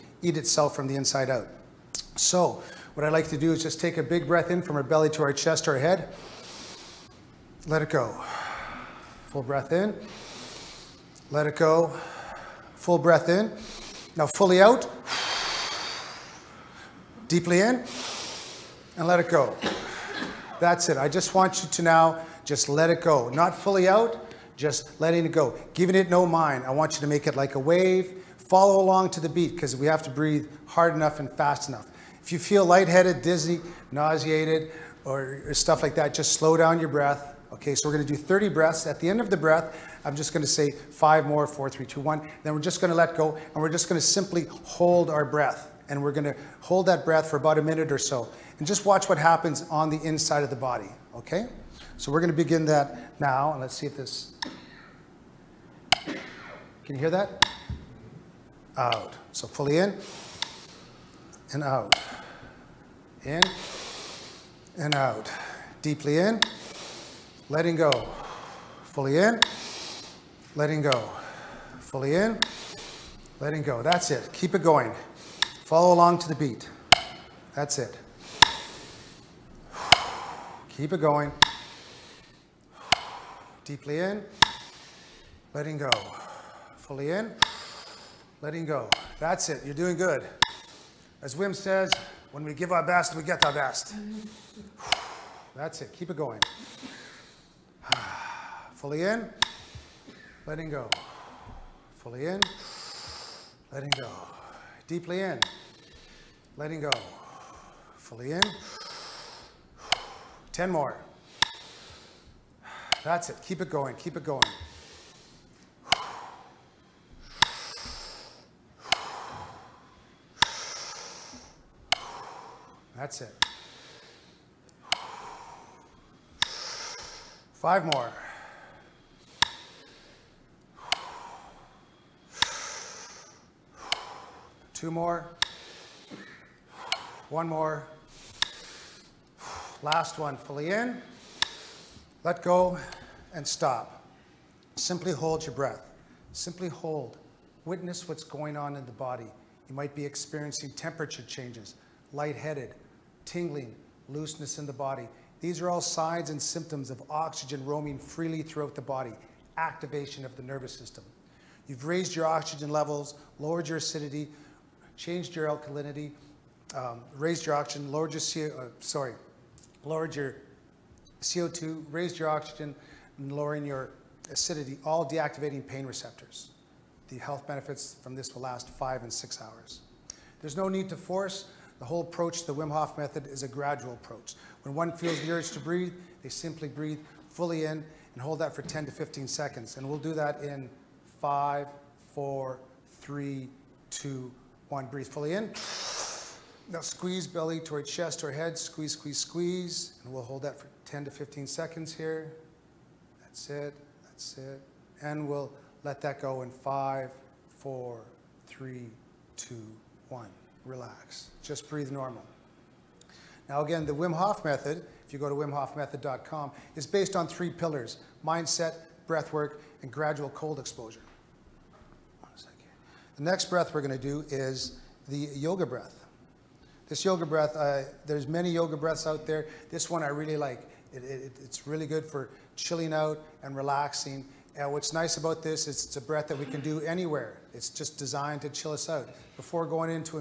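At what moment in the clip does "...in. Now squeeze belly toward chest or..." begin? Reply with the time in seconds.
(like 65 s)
195 s.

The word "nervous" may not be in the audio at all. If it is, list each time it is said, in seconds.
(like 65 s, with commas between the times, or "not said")
160 s.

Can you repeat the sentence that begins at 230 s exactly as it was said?
It, it, it's really good for chilling out and relaxing.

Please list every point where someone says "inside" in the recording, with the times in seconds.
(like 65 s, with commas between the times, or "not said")
0 s, 50 s.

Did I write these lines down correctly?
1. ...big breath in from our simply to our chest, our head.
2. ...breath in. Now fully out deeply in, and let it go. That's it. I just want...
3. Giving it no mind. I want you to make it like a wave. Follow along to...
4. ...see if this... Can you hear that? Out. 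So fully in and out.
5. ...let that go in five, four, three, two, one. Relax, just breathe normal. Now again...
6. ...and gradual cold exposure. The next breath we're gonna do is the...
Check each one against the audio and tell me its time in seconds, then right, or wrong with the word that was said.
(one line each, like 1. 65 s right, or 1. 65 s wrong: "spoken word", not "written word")
1. 4 s wrong: "belly", not "simply"
2. 12 s right
3. 25 s right
4. 53 s right
5. 205 s right
6. 219 s right.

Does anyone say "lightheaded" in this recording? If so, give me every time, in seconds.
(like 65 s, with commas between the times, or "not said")
32 s, 152 s.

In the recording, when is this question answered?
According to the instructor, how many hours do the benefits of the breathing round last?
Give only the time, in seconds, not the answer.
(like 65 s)
178 s.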